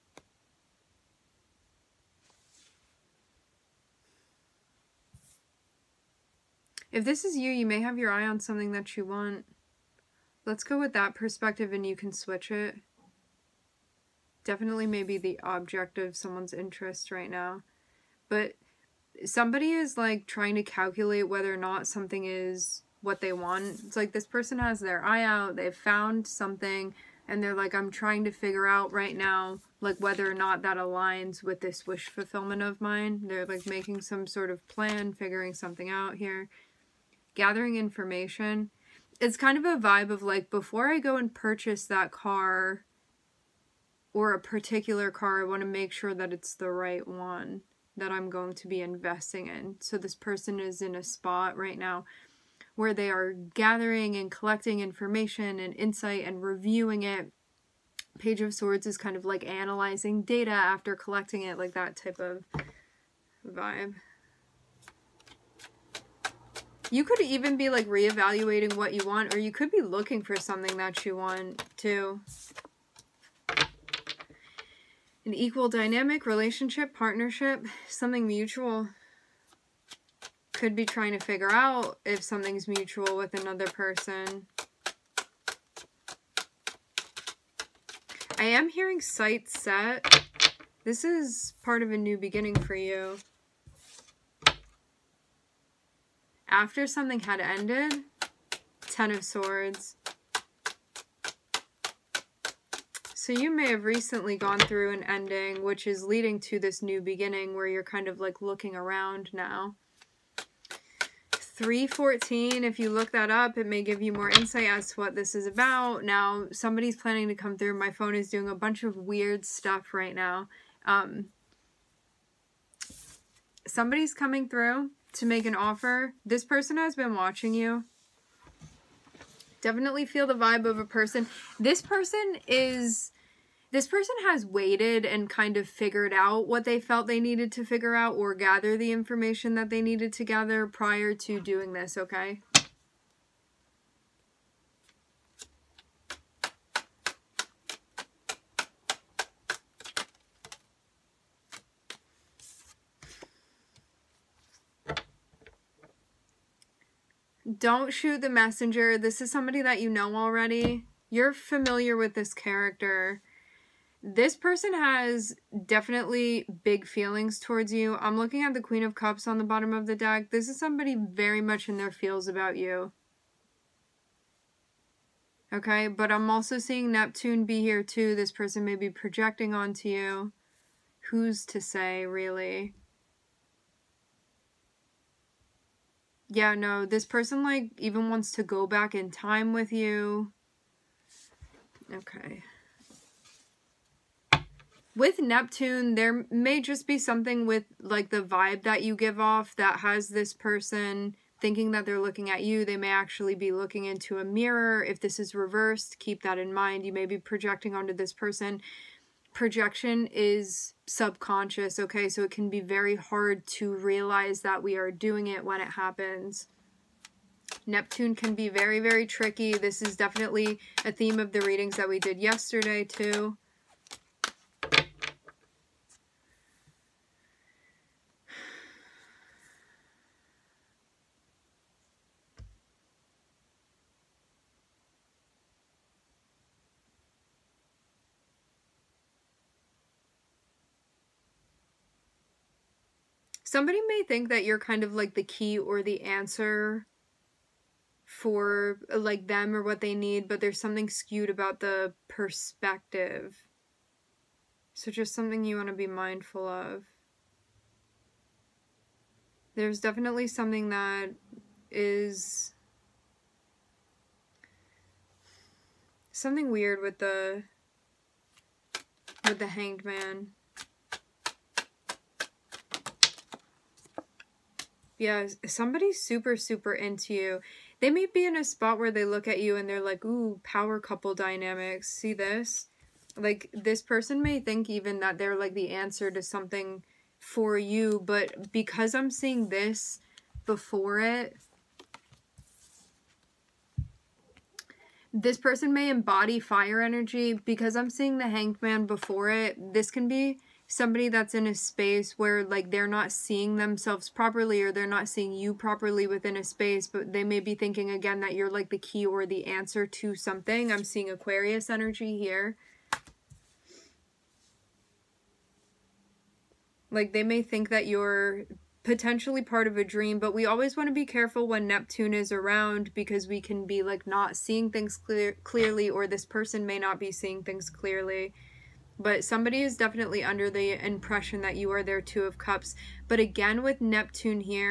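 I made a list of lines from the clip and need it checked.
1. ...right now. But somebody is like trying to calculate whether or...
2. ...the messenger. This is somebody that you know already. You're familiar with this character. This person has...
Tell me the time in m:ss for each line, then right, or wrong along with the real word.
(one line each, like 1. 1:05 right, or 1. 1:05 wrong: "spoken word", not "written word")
1. 0:17 right
2. 2:38 right.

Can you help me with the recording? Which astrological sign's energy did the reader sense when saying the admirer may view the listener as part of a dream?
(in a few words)
Aquarius.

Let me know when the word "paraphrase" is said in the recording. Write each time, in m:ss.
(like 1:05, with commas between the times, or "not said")
not said.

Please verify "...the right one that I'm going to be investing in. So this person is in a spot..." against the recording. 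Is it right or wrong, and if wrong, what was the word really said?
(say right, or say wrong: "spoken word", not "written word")
right.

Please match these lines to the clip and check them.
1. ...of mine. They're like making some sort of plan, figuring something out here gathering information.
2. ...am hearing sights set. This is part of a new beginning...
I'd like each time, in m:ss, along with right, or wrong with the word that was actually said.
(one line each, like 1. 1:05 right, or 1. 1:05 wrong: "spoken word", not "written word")
1. 0:32 right
2. 1:28 right.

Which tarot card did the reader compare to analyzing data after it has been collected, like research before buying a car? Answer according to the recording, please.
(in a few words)
Page of Swords.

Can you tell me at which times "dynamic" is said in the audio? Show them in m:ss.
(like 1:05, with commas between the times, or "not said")
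1:15, 4:41.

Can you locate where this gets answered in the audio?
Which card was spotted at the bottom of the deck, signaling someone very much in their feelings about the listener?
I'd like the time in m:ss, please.
2:48.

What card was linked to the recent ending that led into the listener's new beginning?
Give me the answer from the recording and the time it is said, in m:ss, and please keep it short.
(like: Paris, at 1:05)
Ten of Swords, at 1:38.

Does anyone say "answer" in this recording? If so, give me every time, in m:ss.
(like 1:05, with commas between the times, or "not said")
4:06, 4:45, 5:09.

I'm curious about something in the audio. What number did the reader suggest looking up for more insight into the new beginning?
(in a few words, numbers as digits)
314.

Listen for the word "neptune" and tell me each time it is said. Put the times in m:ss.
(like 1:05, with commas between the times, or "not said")
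2:56, 3:15, 3:37, 5:21, 5:33.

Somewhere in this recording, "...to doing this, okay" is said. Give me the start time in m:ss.
2:21.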